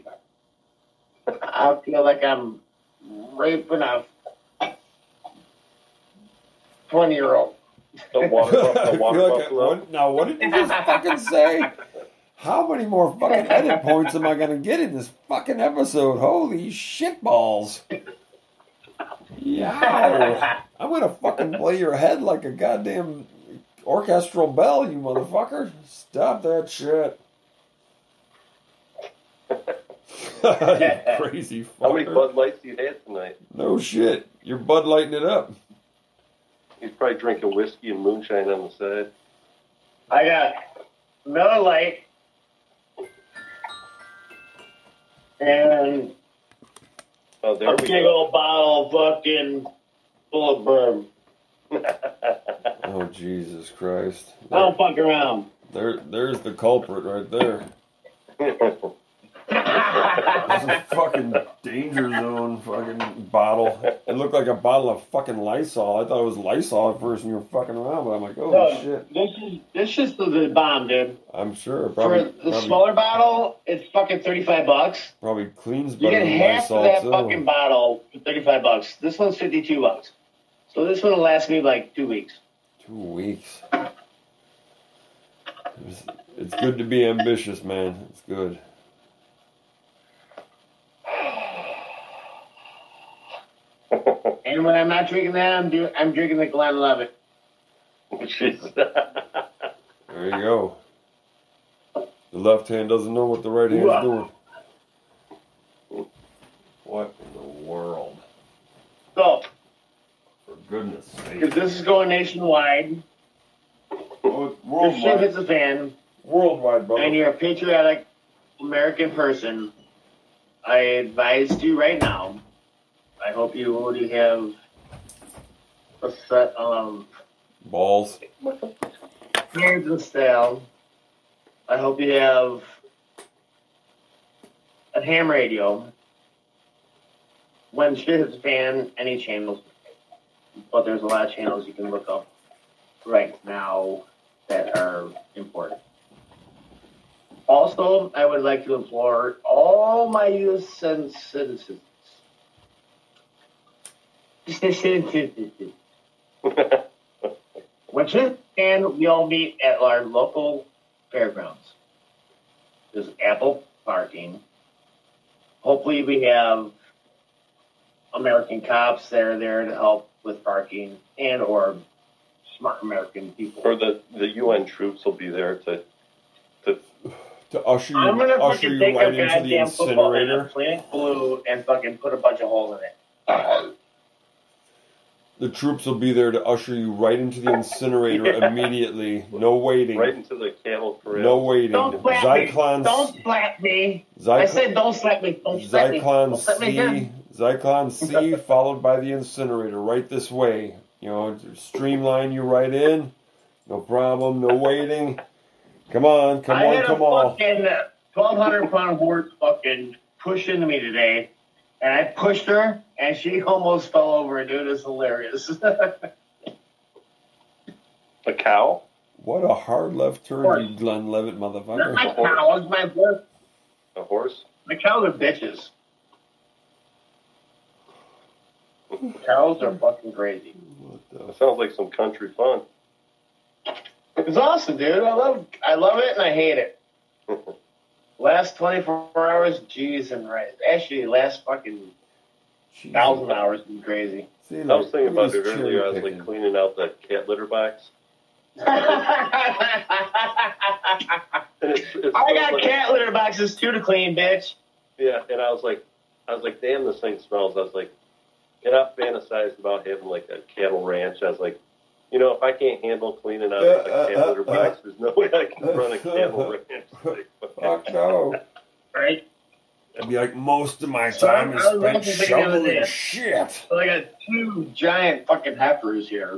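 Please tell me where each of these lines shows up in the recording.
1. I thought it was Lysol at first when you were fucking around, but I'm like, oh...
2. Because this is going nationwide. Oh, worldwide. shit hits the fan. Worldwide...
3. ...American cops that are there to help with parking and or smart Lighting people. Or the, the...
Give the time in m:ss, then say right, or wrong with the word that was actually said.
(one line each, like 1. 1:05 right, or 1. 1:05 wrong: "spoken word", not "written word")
1. 1:06 right
2. 1:51 right
3. 2:48 wrong: "American", not "Lighting".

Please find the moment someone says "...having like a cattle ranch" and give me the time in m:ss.
4:19.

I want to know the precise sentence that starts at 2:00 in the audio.
I advise you right now I hope you already have a set of balls, hands and style.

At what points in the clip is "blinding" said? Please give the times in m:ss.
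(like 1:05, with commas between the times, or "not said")
not said.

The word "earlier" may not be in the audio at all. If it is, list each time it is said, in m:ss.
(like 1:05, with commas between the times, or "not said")
4:05.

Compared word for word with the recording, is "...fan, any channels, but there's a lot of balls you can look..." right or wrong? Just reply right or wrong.
wrong.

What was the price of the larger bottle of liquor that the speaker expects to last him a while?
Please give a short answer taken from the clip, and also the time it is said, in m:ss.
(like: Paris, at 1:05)
52 bucks, at 1:19.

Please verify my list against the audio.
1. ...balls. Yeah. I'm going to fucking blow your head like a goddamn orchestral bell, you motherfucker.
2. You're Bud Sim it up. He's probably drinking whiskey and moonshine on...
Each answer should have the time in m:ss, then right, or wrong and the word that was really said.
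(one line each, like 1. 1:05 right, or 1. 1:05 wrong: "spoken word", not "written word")
1. 0:17 right
2. 0:34 wrong: "Lighting", not "Sim".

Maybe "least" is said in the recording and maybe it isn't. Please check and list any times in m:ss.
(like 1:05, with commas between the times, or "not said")
not said.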